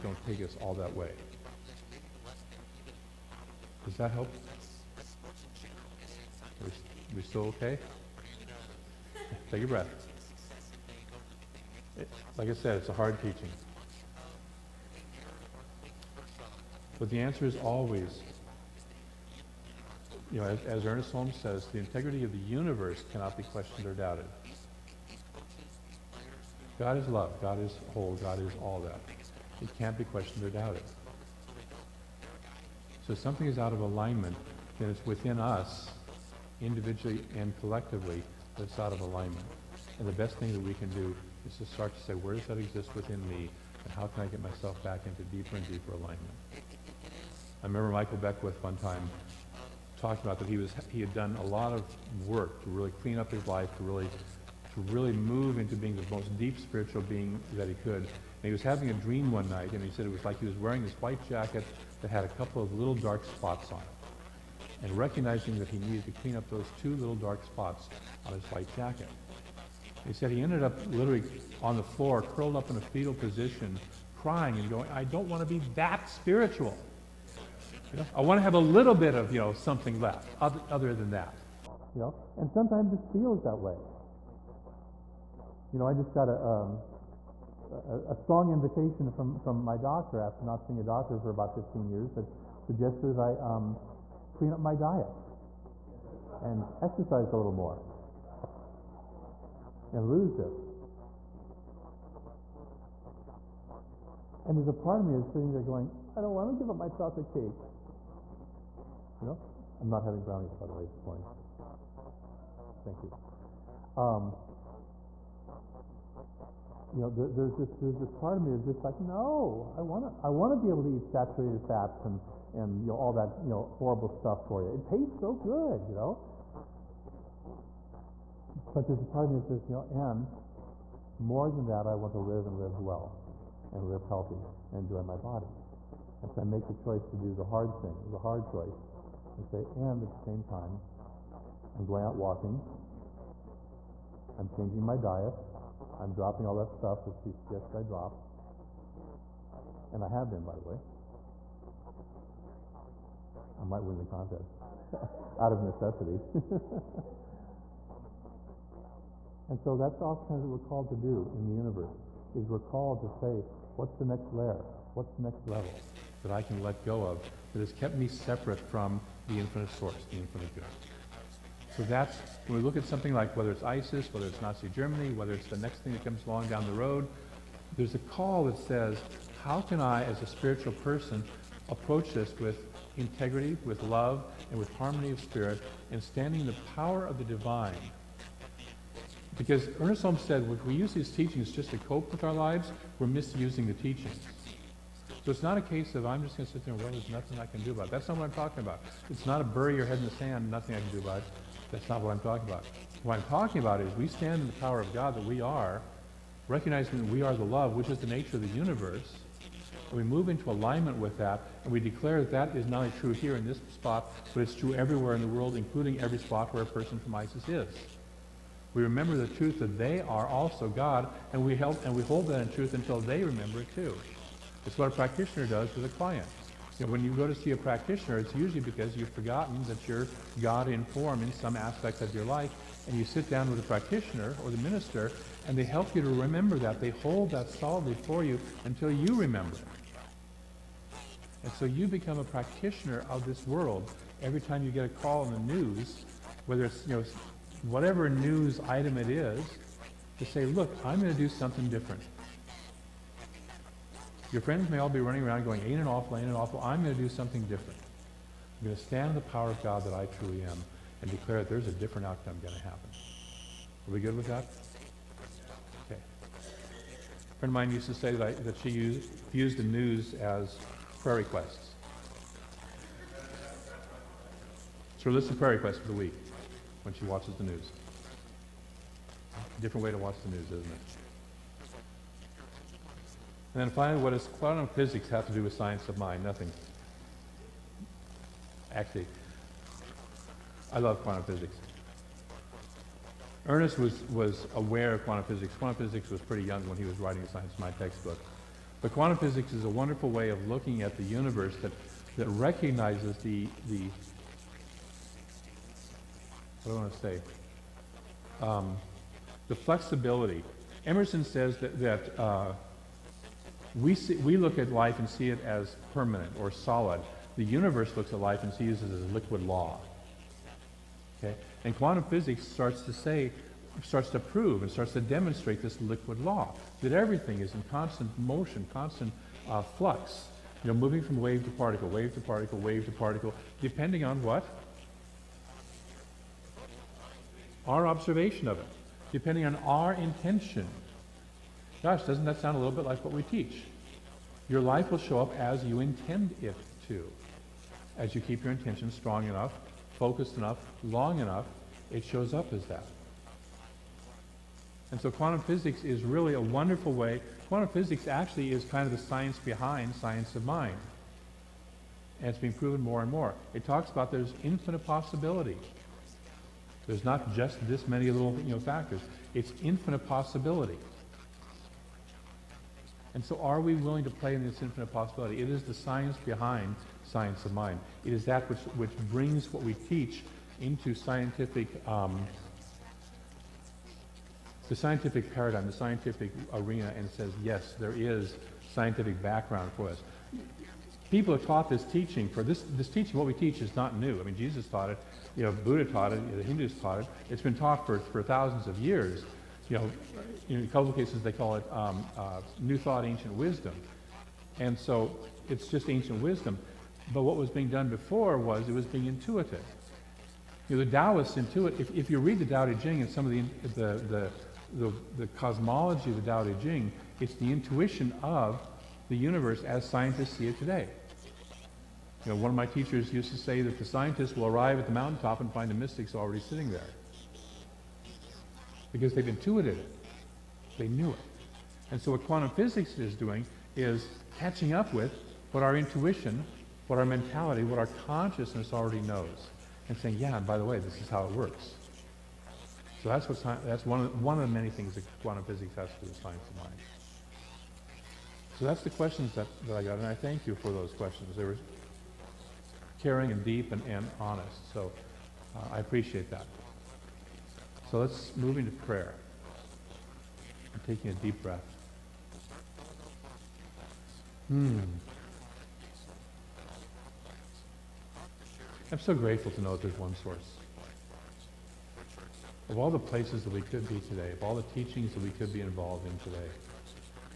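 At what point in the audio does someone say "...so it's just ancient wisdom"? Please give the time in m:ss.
6:44.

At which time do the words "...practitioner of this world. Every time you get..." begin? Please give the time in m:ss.
4:02.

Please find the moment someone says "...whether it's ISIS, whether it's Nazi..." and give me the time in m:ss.
2:53.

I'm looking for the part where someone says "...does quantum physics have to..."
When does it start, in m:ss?
4:44.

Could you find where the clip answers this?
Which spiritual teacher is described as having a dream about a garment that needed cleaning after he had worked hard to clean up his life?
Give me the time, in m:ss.
0:47.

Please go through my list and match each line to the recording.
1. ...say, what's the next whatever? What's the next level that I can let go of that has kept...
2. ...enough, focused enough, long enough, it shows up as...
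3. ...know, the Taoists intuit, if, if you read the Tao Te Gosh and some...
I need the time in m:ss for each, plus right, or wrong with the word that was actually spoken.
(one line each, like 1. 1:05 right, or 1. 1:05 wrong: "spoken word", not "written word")
1. 2:43 wrong: "layer", not "whatever"
2. 5:49 right
3. 6:50 wrong: "Ching", not "Gosh".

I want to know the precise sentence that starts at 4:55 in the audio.
Quantum physics was pretty young when he was writing a Science of Mind textbook.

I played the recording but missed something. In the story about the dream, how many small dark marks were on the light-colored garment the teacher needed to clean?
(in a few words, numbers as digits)
2.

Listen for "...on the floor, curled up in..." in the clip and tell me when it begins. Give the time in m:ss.
1:11.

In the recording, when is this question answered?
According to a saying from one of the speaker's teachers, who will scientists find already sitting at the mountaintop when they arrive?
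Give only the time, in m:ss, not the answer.
7:05.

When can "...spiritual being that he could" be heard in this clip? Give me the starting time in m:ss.
0:56.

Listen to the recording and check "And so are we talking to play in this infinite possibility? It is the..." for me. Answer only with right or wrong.
wrong.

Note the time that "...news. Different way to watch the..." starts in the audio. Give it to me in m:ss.
4:37.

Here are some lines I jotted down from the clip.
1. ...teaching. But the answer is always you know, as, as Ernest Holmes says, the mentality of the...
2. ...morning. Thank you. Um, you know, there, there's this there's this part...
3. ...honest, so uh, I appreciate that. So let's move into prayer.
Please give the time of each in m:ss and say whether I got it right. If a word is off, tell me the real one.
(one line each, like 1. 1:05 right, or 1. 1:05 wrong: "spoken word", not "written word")
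1. 0:13 wrong: "integrity", not "mentality"
2. 1:51 right
3. 7:34 right.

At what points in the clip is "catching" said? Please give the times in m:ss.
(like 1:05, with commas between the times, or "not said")
7:14.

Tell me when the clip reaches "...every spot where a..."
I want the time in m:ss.
3:36.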